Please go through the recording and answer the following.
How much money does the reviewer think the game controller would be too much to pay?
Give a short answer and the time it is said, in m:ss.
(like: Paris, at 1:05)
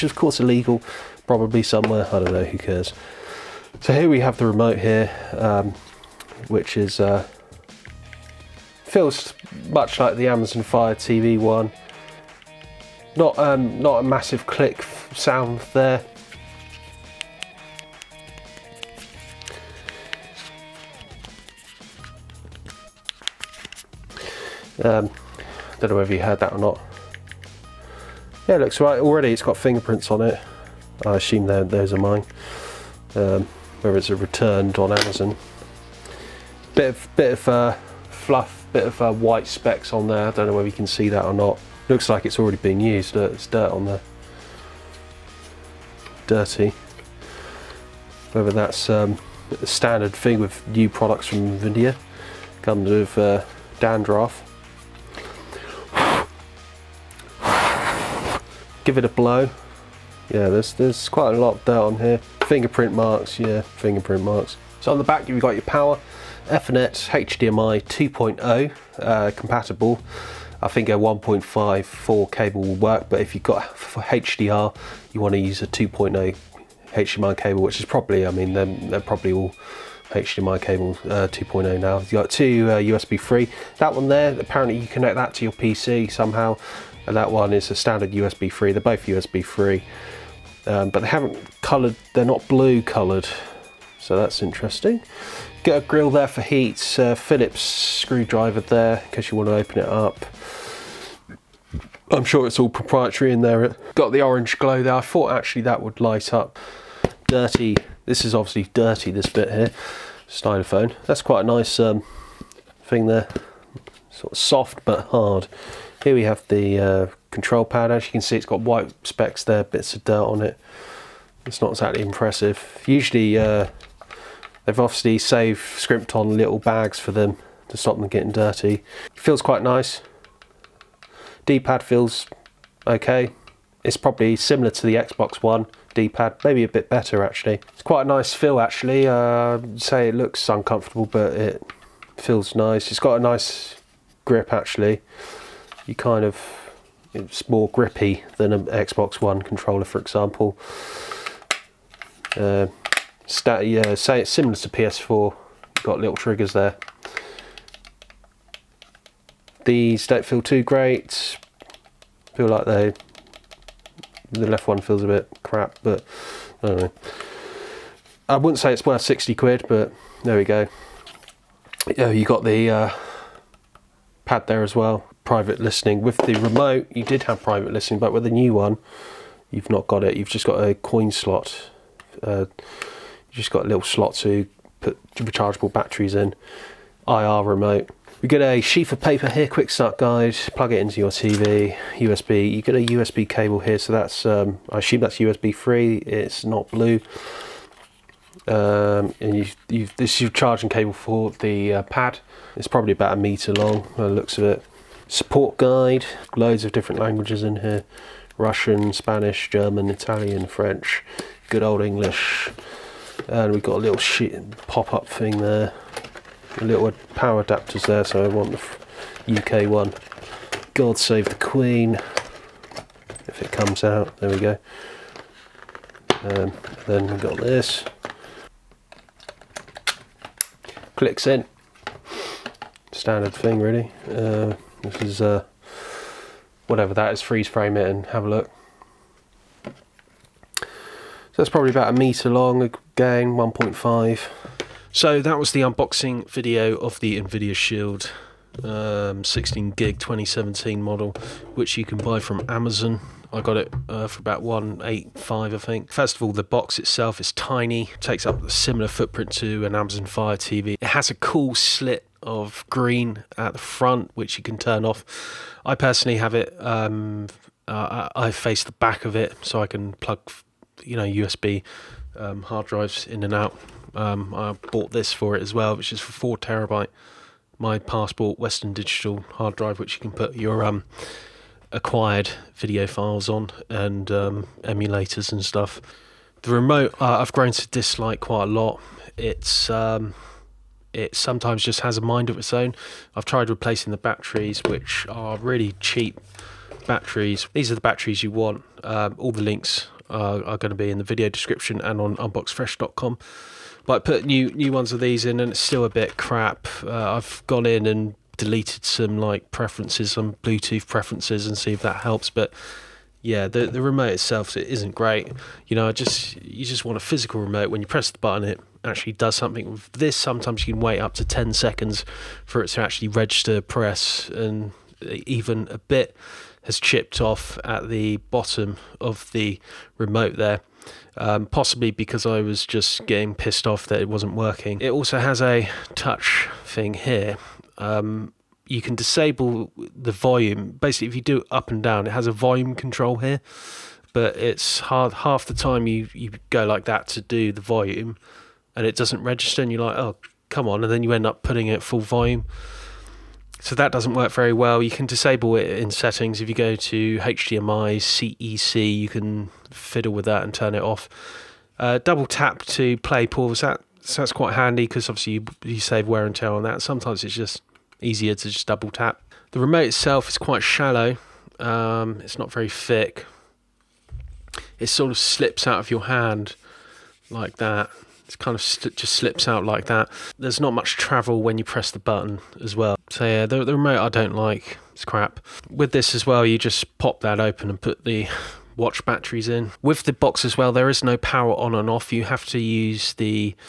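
60 quid, at 2:49.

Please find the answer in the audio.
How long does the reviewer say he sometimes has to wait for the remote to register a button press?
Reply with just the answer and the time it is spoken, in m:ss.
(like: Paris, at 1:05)
10 seconds, at 5:21.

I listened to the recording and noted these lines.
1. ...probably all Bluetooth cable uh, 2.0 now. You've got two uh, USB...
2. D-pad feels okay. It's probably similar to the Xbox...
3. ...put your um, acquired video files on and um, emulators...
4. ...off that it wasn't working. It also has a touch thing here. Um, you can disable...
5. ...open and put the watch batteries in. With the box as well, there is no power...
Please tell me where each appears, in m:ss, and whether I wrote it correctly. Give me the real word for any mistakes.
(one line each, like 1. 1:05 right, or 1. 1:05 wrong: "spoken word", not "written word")
1. 1:19 wrong: "HDMI", not "Bluetooth"
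2. 2:11 right
3. 4:40 right
4. 5:33 right
5. 6:27 right.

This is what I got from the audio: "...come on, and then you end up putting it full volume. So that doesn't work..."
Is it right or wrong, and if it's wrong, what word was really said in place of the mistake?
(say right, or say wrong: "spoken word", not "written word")
right.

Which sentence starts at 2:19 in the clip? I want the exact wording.
Uh, say it looks uncomfortable, but it feels nice.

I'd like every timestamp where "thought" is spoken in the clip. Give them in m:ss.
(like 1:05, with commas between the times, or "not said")
1:45.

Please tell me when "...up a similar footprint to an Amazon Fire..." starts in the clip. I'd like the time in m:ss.
4:18.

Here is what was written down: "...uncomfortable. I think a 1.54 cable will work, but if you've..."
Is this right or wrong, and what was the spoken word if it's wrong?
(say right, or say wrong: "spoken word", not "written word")
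wrong: "compatible", not "uncomfortable".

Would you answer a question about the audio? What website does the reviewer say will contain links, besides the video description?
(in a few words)
unboxfresh.com.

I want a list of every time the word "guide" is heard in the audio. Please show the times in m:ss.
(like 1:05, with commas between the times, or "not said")
3:09, 3:25.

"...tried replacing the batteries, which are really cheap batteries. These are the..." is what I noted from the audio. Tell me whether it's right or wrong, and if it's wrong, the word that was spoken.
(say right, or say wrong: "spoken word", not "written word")
right.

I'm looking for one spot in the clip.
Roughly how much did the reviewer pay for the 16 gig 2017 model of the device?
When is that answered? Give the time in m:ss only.
4:14.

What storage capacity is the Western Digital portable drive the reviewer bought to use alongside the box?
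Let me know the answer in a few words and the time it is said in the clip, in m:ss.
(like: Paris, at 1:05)
4 terabytes, at 4:36.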